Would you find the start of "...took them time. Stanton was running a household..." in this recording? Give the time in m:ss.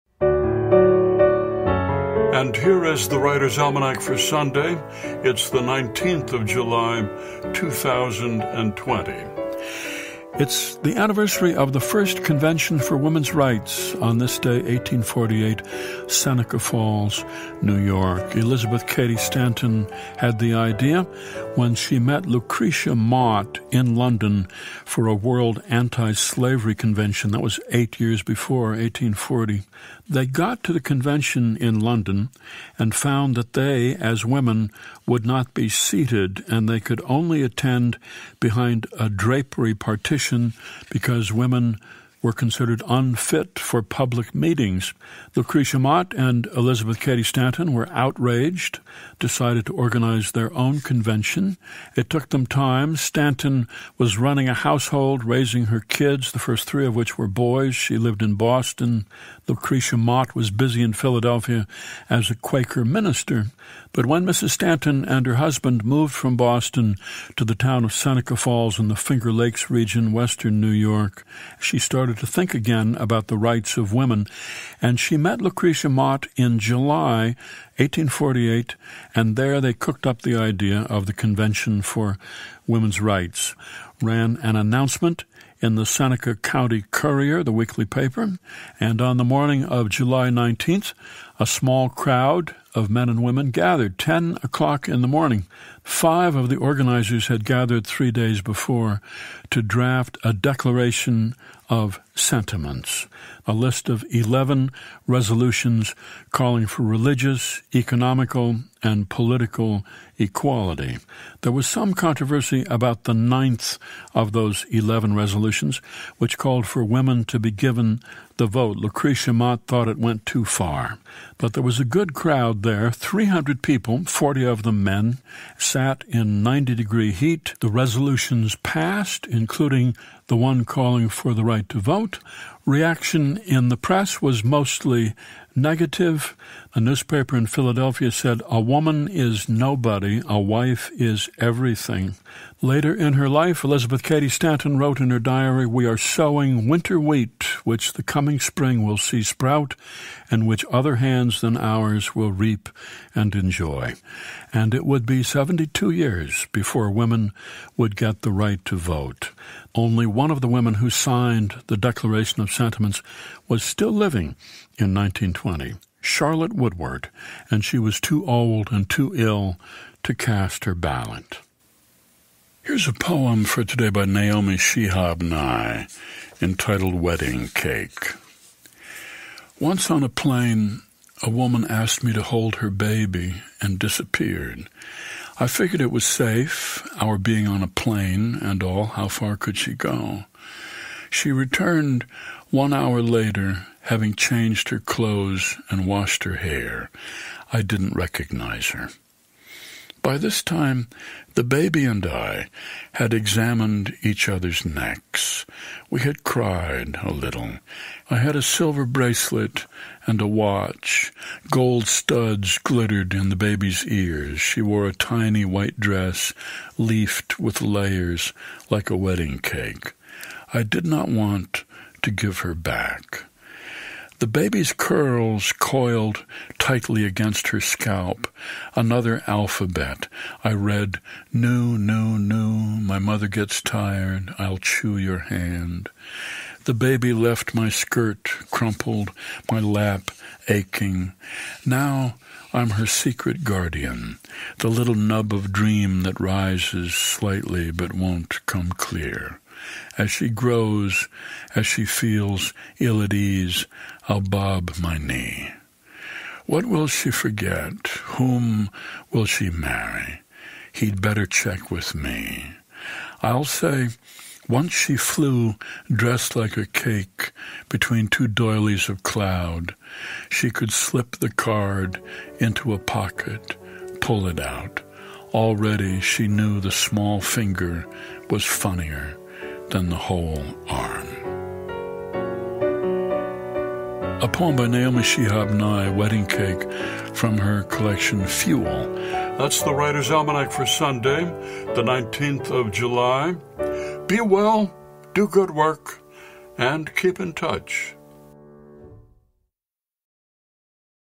0:52.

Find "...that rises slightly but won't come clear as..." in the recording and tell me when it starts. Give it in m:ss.
4:06.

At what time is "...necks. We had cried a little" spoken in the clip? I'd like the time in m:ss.
3:24.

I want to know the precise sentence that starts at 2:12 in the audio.
Reaction in the press was mostly negative.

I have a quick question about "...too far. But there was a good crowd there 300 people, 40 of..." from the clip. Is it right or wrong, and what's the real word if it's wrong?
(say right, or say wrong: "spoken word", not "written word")
right.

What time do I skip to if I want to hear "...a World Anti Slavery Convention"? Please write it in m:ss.
0:25.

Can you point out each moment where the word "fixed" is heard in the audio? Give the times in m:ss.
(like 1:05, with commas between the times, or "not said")
not said.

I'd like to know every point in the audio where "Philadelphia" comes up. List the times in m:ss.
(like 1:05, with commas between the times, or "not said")
1:00, 2:17.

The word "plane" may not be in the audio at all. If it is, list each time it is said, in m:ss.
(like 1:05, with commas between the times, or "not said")
3:00, 3:07.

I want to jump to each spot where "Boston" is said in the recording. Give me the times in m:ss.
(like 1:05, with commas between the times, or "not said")
0:58, 1:06.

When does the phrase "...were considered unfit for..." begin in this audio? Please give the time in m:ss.
0:42.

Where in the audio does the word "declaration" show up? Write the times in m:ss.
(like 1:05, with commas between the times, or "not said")
1:40, 2:41.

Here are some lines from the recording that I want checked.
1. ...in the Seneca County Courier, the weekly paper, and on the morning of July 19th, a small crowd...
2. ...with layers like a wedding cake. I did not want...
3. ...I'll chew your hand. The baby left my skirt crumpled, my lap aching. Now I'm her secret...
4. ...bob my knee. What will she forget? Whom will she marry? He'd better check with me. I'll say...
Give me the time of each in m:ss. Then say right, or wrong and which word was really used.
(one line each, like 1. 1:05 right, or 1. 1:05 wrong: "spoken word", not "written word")
1. 1:25 right
2. 3:37 right
3. 3:54 right
4. 4:14 right.